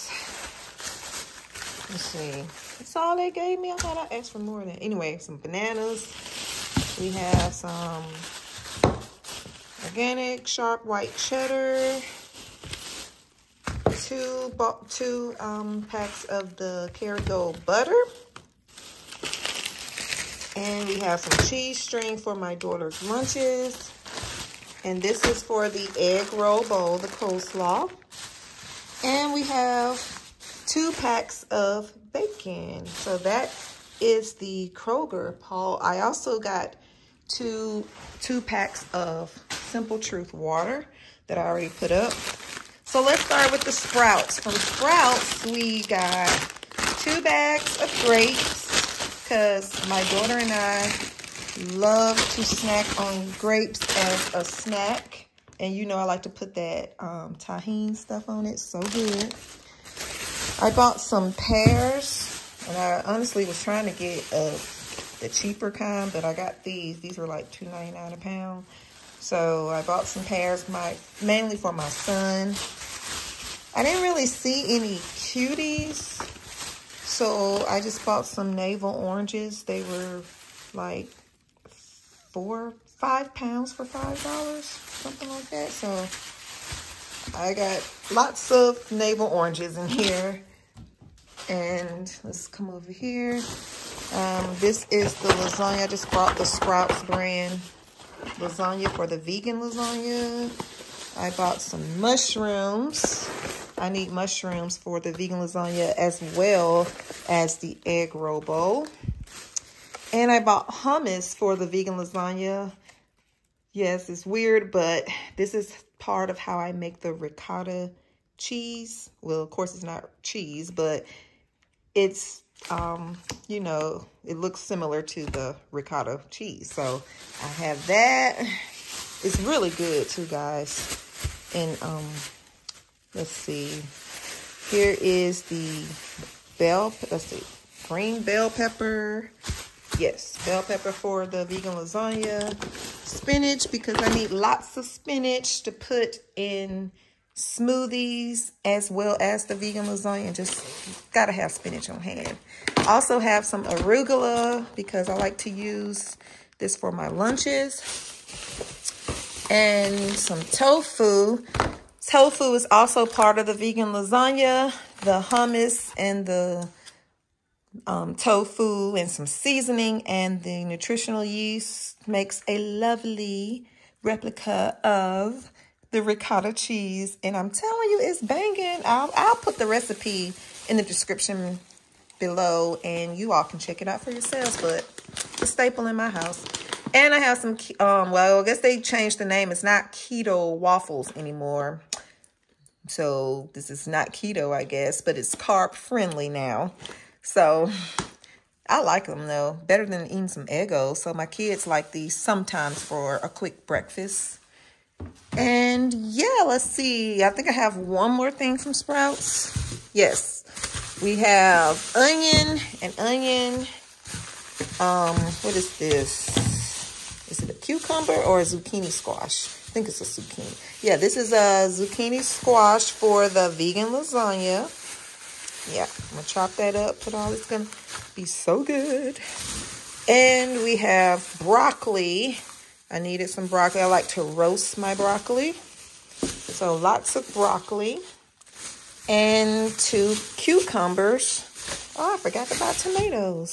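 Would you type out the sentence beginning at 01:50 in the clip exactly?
And I bought hummus for the vegan lasagna.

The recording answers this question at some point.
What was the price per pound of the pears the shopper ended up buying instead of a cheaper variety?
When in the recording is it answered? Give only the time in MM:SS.
01:07.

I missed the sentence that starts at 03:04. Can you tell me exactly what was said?
But a staple in my house.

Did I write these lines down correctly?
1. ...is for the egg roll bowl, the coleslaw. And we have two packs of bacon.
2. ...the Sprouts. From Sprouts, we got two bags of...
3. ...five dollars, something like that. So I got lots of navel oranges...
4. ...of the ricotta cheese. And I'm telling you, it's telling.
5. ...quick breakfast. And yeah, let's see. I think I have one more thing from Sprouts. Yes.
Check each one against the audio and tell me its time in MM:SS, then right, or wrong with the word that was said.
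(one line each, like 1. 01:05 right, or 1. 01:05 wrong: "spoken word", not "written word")
1. 00:25 right
2. 00:43 right
3. 01:23 right
4. 02:54 wrong: "banging", not "telling"
5. 03:23 right.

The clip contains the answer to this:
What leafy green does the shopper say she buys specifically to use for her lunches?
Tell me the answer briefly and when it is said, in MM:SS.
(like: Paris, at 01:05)
arugula, at 02:33.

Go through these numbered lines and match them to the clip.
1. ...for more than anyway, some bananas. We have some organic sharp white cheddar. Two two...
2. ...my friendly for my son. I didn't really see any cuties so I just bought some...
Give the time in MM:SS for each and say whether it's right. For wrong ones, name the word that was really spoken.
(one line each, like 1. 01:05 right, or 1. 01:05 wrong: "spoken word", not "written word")
1. 00:04 right
2. 01:10 wrong: "mainly", not "friendly".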